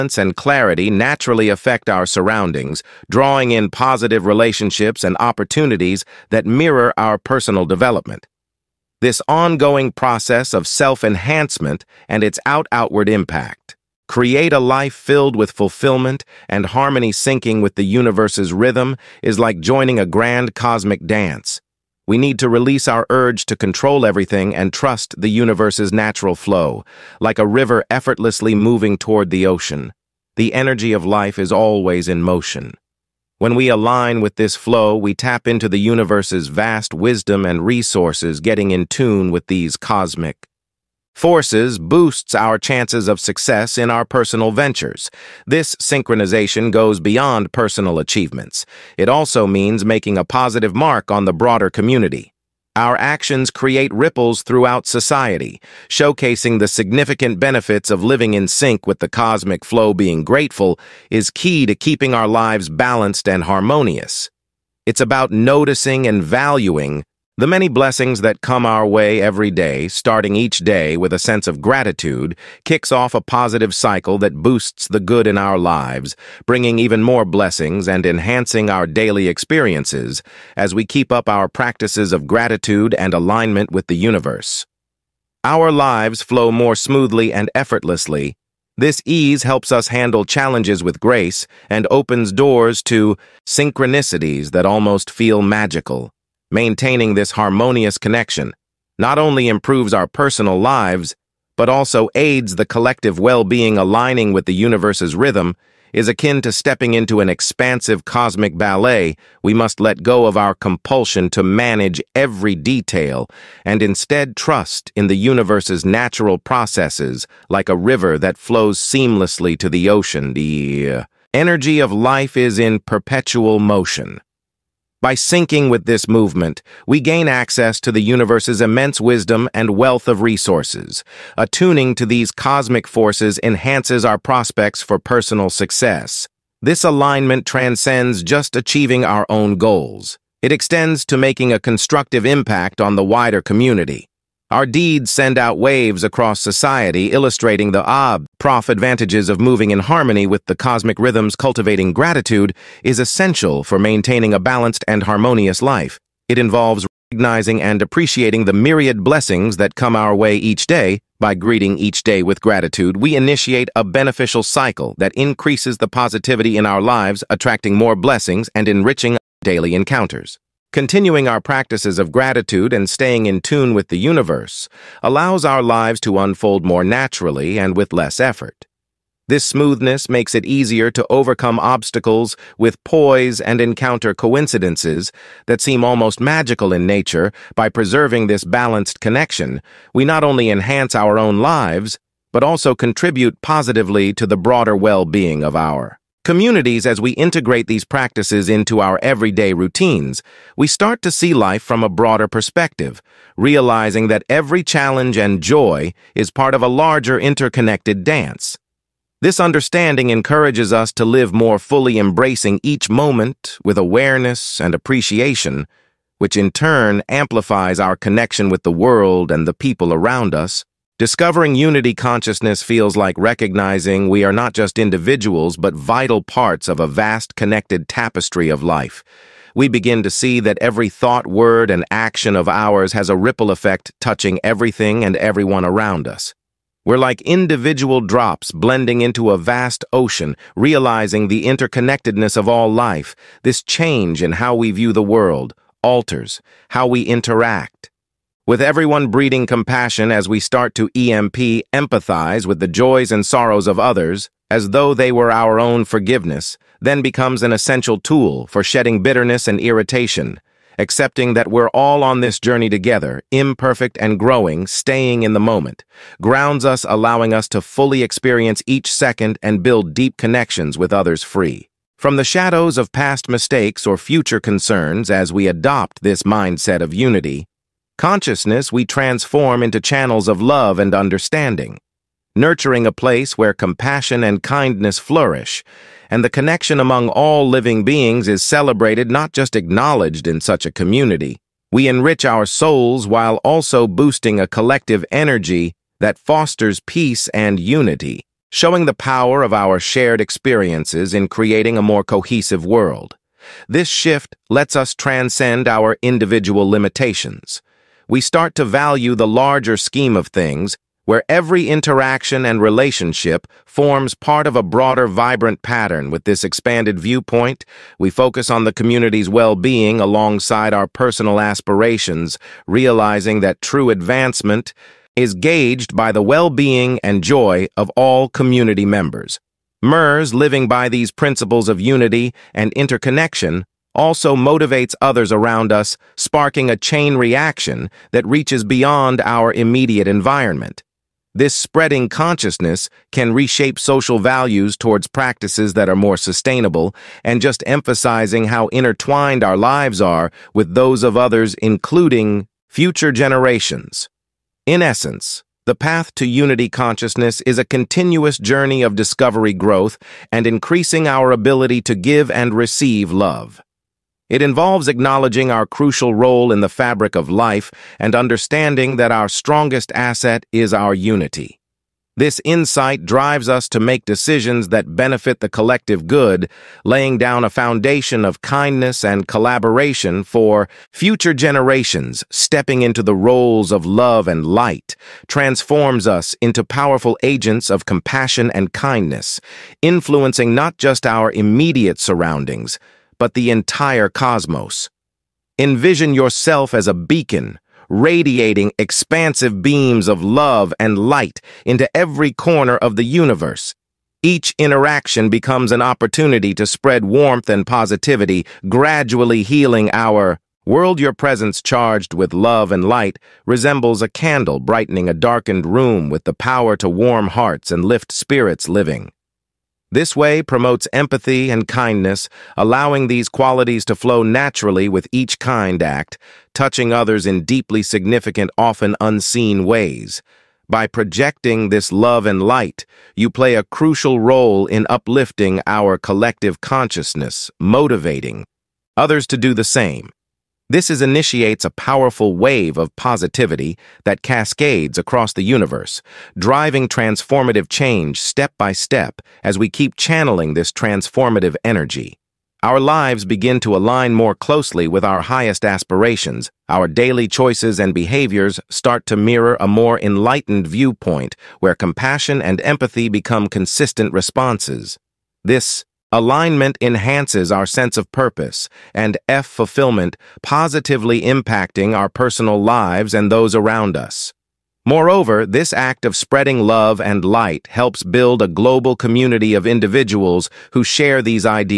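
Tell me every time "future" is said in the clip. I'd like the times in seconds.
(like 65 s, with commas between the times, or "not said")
273 s, 352 s, 380 s.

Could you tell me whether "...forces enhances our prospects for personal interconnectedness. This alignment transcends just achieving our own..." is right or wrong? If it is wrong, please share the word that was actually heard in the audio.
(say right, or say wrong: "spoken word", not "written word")
wrong: "success", not "interconnectedness".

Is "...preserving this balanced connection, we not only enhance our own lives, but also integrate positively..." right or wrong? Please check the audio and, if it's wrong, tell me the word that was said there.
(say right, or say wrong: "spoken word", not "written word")
wrong: "contribute", not "integrate".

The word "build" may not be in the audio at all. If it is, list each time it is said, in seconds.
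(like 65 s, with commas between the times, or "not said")
269 s, 478 s.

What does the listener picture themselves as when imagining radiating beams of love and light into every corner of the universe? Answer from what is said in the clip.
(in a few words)
a beacon.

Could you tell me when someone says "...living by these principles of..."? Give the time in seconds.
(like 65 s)
330 s.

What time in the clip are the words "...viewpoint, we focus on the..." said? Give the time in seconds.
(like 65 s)
316 s.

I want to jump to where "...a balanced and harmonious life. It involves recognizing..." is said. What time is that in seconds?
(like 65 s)
154 s.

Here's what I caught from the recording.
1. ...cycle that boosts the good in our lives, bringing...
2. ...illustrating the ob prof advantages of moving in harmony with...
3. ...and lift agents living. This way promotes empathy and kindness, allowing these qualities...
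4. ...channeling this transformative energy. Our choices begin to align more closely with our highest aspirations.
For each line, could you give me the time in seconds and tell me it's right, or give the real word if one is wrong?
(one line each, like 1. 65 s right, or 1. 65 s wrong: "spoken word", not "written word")
1. 73 s right
2. 147 s right
3. 417 s wrong: "spirits", not "agents"
4. 449 s wrong: "lives", not "choices".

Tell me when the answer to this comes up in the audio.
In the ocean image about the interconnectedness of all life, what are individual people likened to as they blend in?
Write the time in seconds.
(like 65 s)
237 s.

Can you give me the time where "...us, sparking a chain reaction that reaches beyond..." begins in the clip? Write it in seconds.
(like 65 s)
335 s.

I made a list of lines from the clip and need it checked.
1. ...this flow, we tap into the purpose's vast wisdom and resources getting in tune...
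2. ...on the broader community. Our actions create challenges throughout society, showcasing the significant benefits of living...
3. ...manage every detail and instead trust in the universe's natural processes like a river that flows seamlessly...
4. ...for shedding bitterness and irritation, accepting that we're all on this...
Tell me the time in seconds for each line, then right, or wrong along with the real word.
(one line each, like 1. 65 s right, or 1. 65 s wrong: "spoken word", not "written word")
1. 34 s wrong: "universe", not "purpose"
2. 51 s wrong: "ripples", not "challenges"
3. 111 s right
4. 258 s right.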